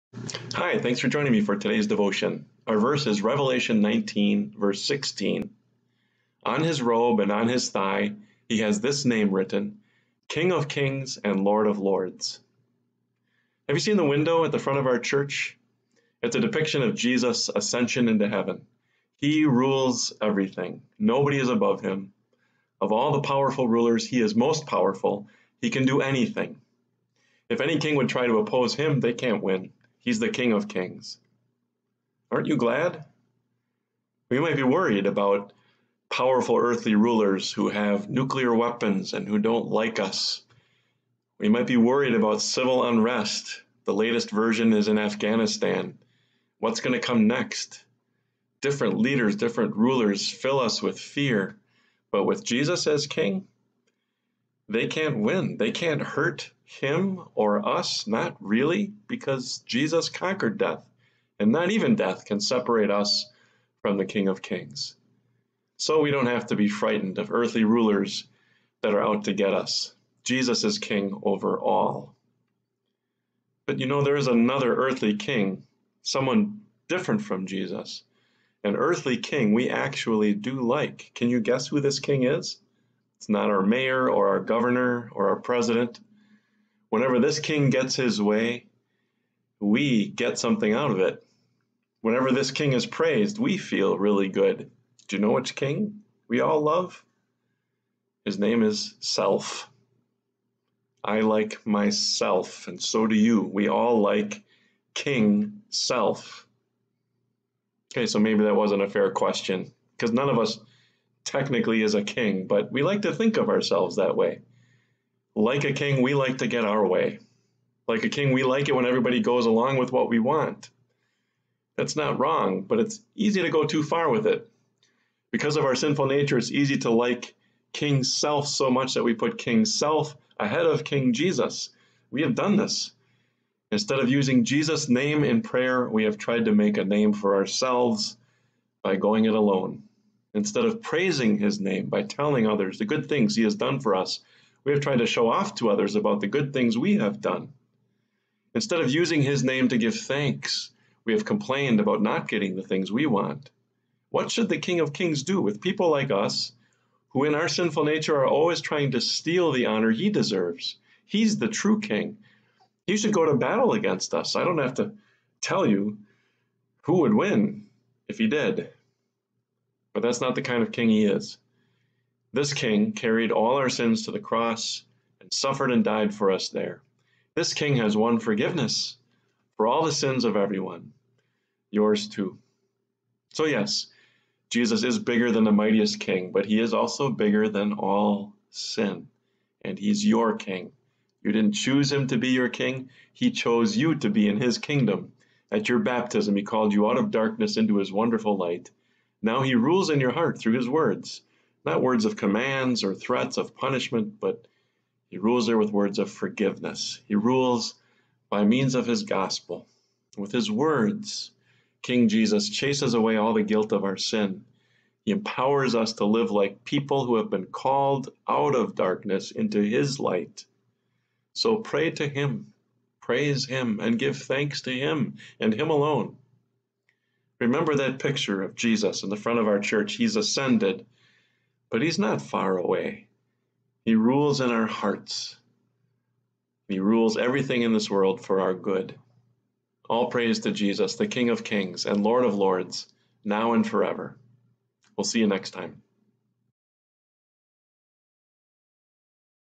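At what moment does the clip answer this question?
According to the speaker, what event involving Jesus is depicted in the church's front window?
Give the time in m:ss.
0:17.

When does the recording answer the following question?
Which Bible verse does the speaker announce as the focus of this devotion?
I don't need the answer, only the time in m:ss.
0:03.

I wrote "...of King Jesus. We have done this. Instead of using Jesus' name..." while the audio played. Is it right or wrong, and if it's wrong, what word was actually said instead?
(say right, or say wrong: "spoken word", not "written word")
right.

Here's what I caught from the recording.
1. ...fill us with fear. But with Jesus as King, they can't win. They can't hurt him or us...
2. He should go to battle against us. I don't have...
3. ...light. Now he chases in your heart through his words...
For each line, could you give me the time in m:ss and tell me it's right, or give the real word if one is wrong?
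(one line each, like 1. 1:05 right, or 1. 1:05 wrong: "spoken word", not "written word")
1. 0:50 right
2. 2:42 right
3. 3:18 wrong: "rules", not "chases".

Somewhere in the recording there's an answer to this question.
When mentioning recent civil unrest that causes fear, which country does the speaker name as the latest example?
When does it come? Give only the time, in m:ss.
0:44.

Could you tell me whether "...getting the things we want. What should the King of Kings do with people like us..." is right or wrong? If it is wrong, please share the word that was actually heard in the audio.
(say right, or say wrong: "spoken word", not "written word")
right.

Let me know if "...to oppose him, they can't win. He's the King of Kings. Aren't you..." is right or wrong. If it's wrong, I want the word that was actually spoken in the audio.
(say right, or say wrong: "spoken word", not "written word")
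right.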